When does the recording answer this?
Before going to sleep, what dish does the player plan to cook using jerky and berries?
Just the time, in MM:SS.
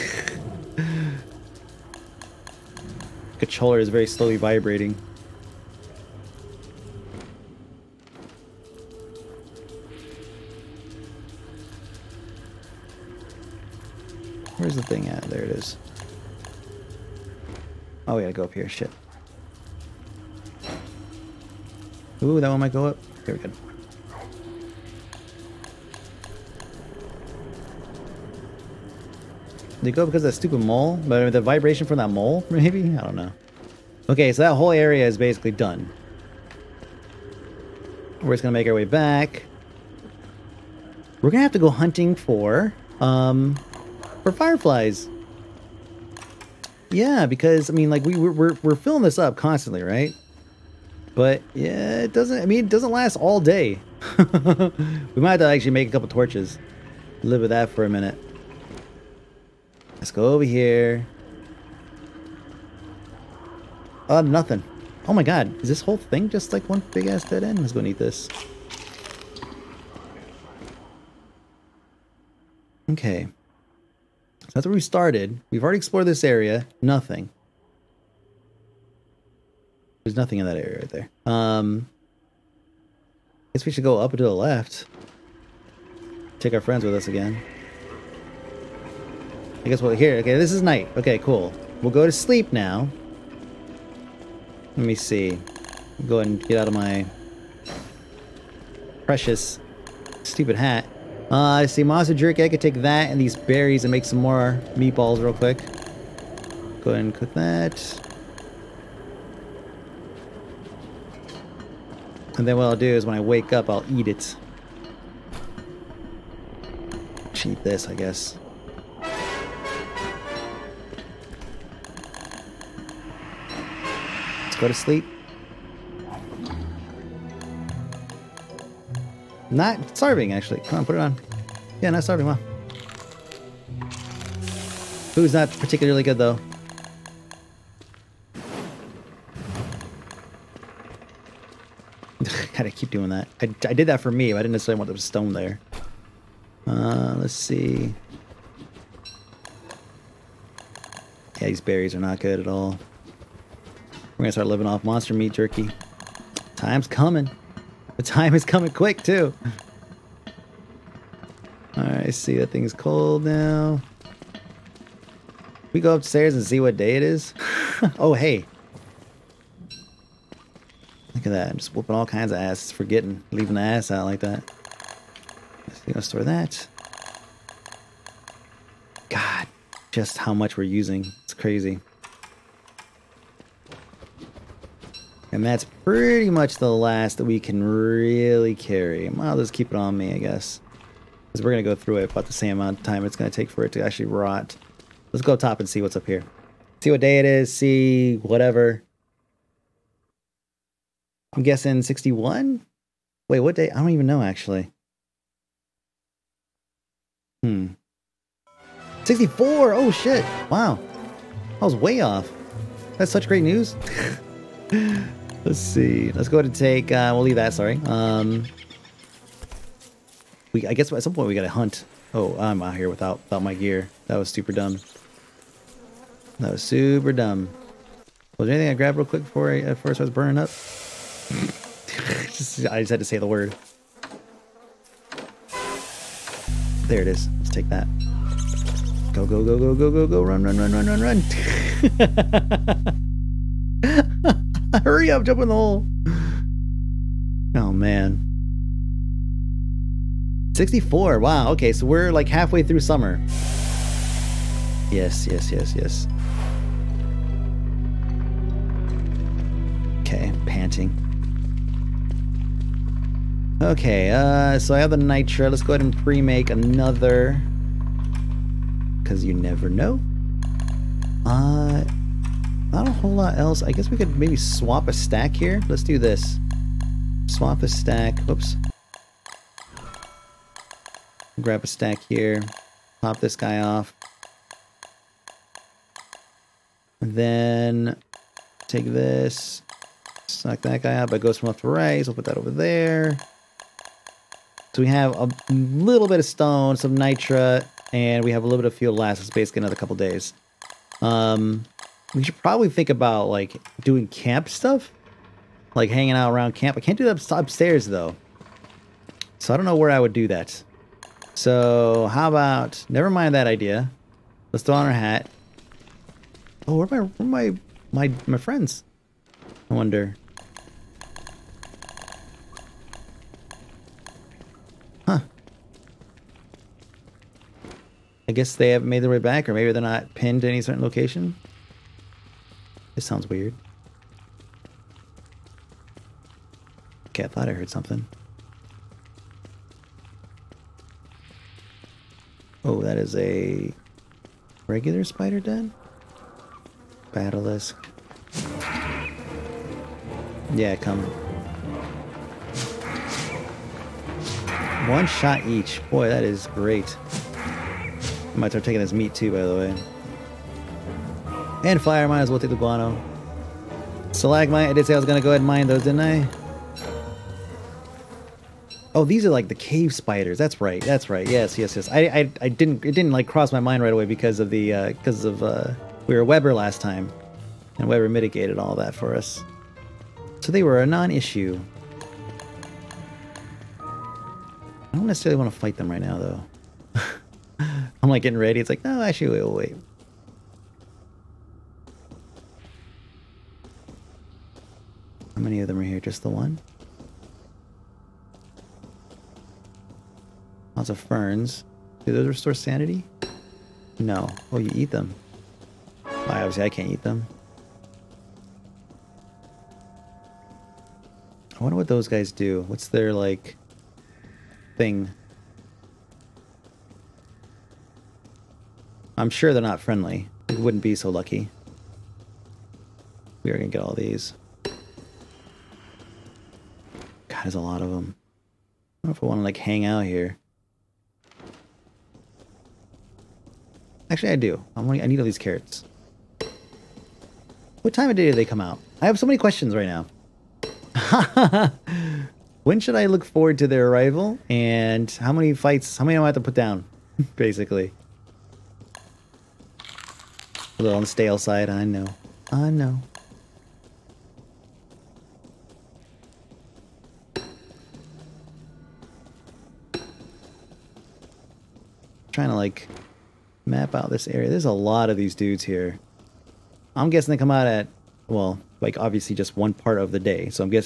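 01:44.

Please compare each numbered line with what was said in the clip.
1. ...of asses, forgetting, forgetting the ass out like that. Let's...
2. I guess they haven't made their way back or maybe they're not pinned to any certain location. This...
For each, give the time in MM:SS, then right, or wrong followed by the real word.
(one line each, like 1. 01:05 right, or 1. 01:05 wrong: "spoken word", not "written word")
1. 02:52 wrong: "leaving", not "forgetting"
2. 05:28 right.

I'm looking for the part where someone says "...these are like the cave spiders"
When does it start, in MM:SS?
06:09.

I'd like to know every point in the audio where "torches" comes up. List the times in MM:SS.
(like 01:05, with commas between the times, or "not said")
00:56.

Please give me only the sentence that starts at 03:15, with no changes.
Let's go top and see what's up here.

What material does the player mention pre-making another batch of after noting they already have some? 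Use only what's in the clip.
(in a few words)
nitro.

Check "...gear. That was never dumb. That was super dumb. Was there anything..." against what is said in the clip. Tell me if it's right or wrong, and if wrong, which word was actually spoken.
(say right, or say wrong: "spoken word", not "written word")
wrong: "super", not "never".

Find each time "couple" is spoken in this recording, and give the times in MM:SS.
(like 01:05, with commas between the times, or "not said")
00:55, 04:59.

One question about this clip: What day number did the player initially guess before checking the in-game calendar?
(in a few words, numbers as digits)
61.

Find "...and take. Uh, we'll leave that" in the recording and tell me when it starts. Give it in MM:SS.
03:36.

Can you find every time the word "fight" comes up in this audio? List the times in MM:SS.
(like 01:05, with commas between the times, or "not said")
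06:25, 07:25.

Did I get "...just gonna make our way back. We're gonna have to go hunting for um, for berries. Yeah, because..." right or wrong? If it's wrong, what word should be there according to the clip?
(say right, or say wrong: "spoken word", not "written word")
wrong: "fireflies", not "berries".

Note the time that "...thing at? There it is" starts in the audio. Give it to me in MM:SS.
00:14.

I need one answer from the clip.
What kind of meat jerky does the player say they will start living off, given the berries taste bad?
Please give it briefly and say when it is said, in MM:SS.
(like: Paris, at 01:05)
monster meat jerky, at 02:34.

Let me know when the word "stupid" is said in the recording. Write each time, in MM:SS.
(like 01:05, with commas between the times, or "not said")
00:30, 01:40.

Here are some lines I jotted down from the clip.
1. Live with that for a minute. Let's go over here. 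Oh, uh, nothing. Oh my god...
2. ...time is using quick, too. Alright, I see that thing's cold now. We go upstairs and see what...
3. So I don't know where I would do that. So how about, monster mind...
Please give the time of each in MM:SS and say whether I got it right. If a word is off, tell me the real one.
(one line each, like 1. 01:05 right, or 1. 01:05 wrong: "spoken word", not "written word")
1. 00:57 right
2. 02:38 wrong: "coming", not "using"
3. 05:09 wrong: "never", not "monster".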